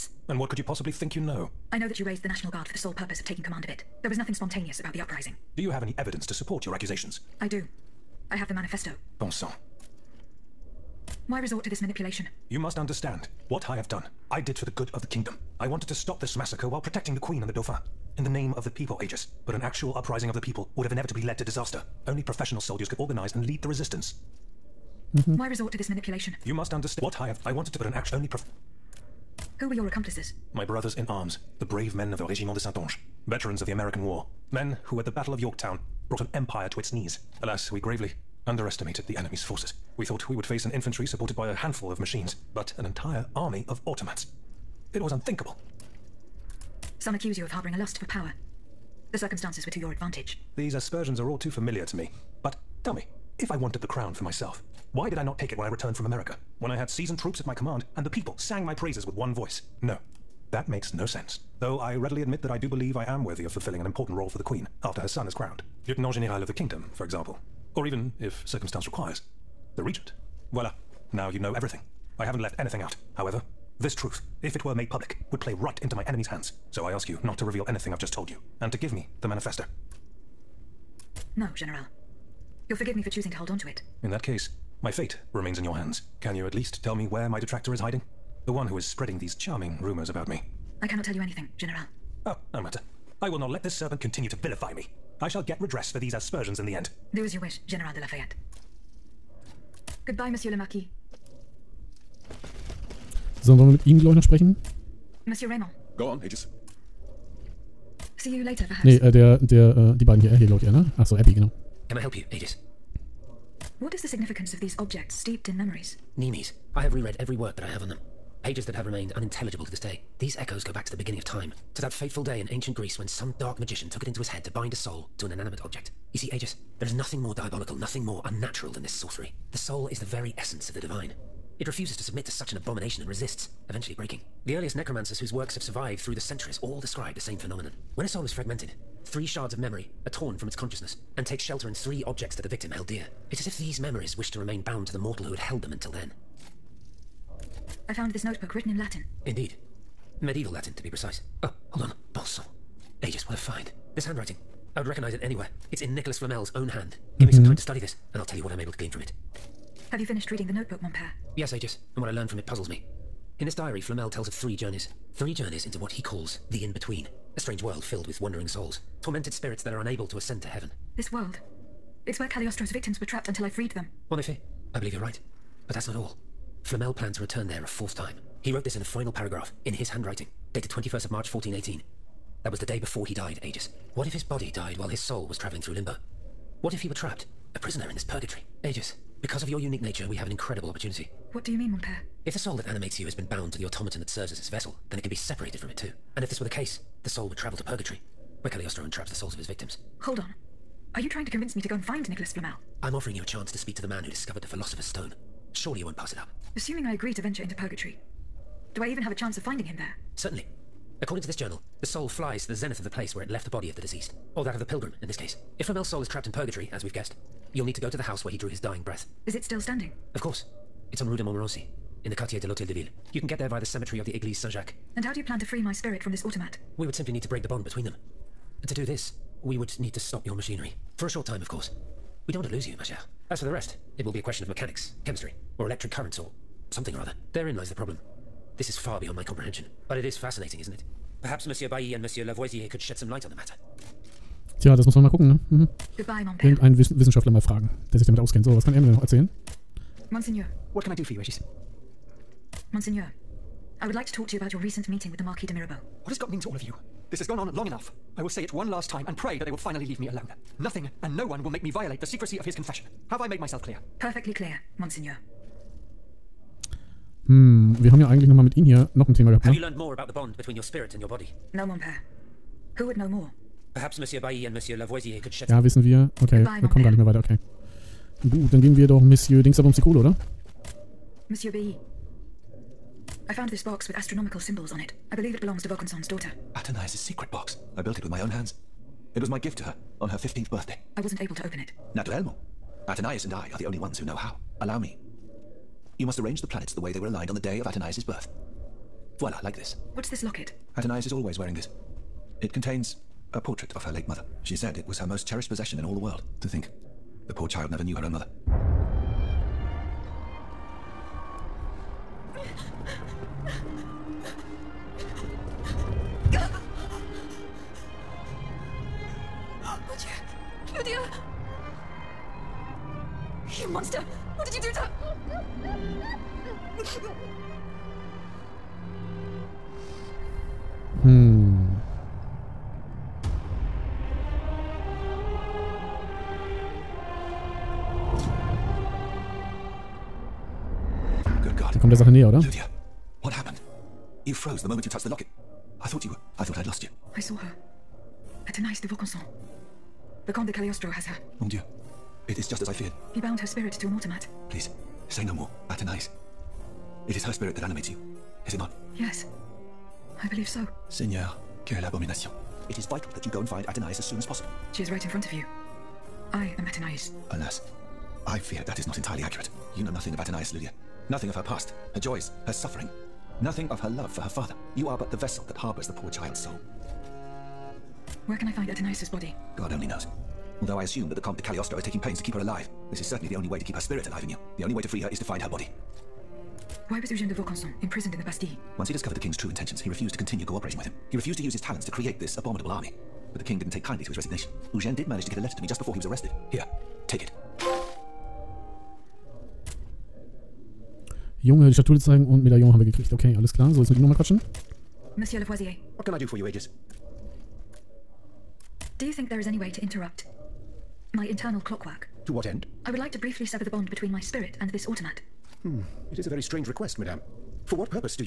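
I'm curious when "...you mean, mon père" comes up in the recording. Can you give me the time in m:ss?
3:11.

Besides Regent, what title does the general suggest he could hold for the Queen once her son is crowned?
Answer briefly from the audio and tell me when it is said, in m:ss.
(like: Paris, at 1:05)
Lieutenant General of the Kingdom, at 1:05.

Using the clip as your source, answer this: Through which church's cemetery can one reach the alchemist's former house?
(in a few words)
Église Saint-Jacques.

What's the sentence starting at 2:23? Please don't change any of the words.
It's as if these memories wish to remain bound to the mortal who had held them until then.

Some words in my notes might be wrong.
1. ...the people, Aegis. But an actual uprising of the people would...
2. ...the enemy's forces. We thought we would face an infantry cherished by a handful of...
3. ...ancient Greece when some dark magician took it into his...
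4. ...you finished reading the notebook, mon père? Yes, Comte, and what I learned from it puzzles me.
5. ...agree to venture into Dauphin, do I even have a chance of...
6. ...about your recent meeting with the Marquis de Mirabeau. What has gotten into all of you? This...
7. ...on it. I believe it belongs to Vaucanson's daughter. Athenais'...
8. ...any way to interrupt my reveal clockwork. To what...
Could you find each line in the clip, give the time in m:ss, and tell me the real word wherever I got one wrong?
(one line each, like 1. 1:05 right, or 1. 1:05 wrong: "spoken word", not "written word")
1. 0:18 right
2. 0:39 wrong: "supported", not "cherished"
3. 2:02 right
4. 2:39 wrong: "Aegis", not "Comte"
5. 3:26 wrong: "Purgatory", not "Dauphin"
6. 4:14 right
7. 4:44 right
8. 6:49 wrong: "internal", not "reveal".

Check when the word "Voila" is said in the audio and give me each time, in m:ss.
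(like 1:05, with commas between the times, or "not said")
1:10, 4:59.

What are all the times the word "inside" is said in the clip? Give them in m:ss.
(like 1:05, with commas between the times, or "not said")
not said.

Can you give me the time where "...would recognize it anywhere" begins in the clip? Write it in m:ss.
2:34.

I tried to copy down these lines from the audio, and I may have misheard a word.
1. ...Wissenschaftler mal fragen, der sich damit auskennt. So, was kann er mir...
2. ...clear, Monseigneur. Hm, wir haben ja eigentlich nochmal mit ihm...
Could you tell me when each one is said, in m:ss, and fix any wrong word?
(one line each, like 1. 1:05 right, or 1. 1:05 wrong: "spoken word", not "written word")
1. 4:06 right
2. 4:24 right.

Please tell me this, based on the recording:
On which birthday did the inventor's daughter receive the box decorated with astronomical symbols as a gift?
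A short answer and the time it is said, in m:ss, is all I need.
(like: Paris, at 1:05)
15th, at 4:50.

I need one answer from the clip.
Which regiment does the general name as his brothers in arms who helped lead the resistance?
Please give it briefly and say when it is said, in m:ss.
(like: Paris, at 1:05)
Régiment de Saintonge, at 0:32.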